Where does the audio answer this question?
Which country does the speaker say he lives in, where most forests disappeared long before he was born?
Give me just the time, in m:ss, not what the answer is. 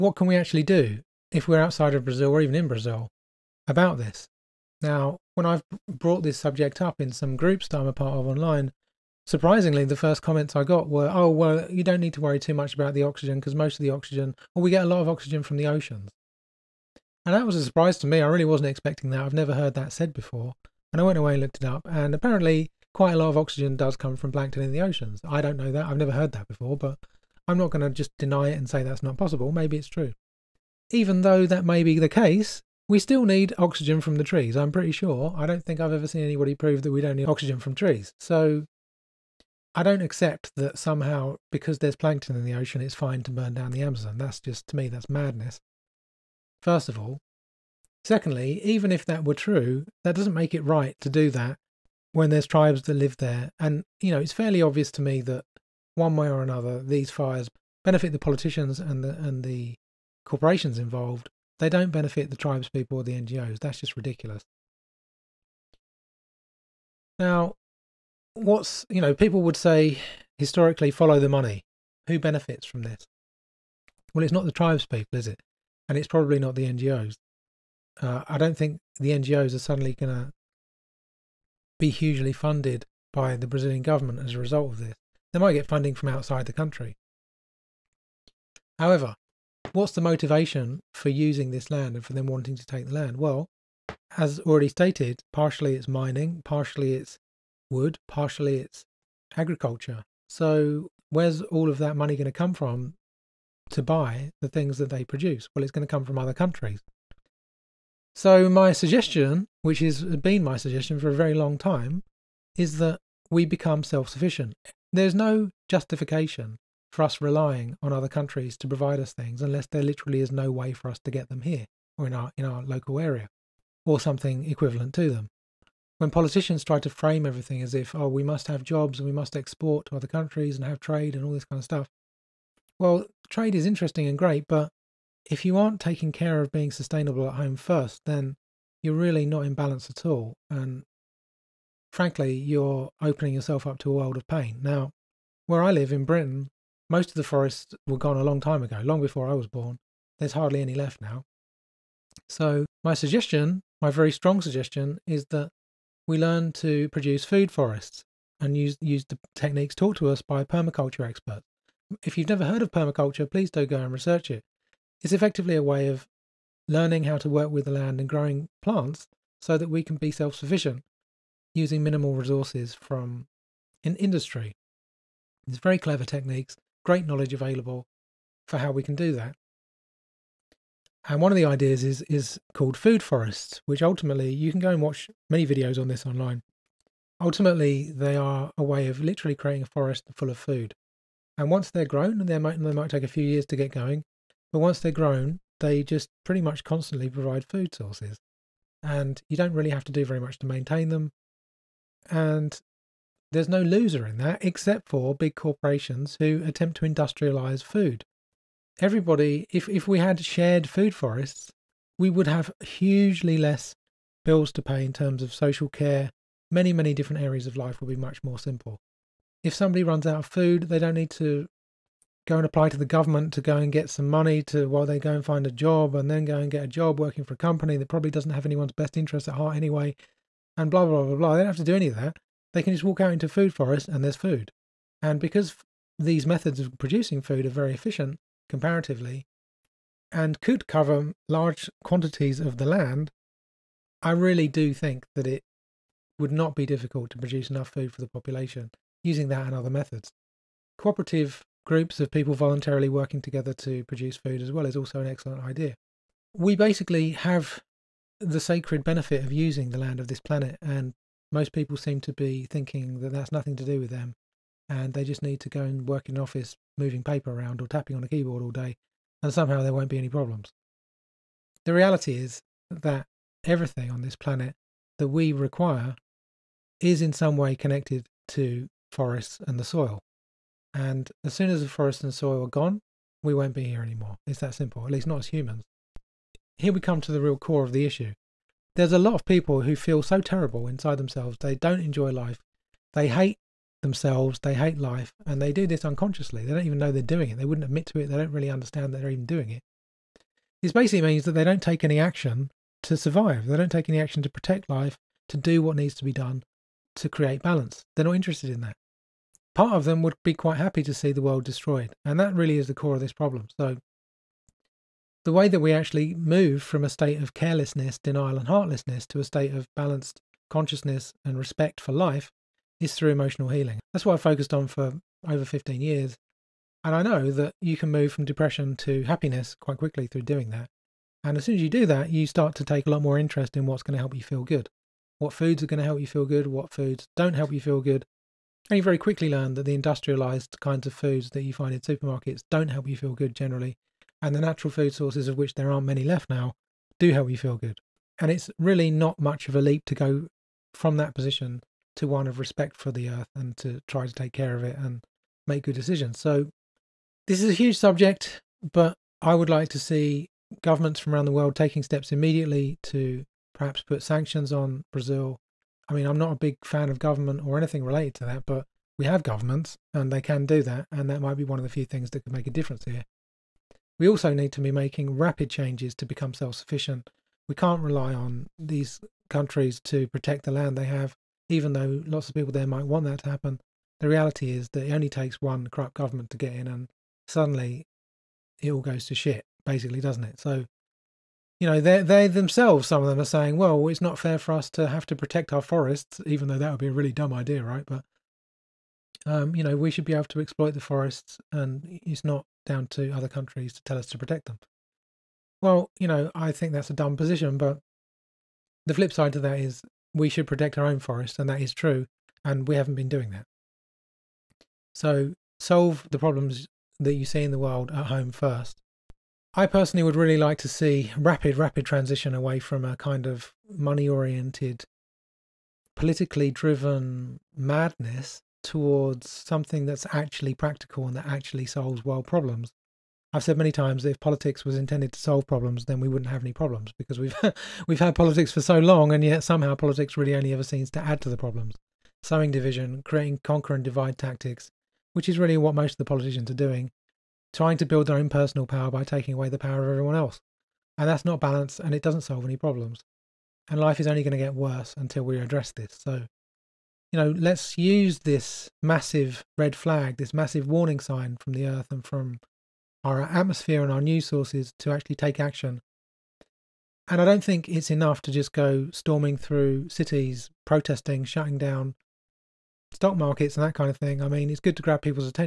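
2:26.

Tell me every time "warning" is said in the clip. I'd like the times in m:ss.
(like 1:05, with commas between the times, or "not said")
7:40.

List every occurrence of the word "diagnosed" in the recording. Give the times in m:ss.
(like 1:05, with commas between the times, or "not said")
not said.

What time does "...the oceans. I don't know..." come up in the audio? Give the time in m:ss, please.
0:24.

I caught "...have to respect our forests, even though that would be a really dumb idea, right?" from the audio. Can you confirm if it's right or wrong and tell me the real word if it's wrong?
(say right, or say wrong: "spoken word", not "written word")
wrong: "protect", not "respect".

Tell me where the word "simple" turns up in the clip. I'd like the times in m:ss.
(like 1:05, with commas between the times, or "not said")
3:38, 4:44.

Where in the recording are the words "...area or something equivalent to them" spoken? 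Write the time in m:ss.
2:03.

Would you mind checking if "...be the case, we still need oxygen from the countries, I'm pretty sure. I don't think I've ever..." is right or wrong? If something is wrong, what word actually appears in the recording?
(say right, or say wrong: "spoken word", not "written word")
wrong: "trees", not "countries".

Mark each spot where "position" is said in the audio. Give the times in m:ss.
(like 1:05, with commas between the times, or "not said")
5:51, 6:47.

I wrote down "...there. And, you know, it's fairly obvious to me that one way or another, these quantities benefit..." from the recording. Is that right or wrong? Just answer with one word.
wrong.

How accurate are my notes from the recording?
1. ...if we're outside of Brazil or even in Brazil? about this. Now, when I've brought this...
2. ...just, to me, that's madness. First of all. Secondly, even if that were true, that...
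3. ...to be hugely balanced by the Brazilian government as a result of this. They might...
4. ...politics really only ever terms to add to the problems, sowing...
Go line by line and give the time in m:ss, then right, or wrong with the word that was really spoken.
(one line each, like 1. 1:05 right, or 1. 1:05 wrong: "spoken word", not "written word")
1. 0:01 right
2. 0:44 right
3. 1:20 wrong: "funded", not "balanced"
4. 7:19 wrong: "seems", not "terms".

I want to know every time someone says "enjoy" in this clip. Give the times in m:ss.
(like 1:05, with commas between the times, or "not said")
4:51.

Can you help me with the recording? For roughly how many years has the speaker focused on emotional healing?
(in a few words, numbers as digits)
over 15 years.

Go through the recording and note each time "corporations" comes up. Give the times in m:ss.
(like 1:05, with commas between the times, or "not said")
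1:00, 3:25.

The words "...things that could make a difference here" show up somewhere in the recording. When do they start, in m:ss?
6:11.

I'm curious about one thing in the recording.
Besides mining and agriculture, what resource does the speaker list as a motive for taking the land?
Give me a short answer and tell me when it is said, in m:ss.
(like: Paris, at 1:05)
wood, at 1:37.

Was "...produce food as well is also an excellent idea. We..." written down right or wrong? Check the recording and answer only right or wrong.
right.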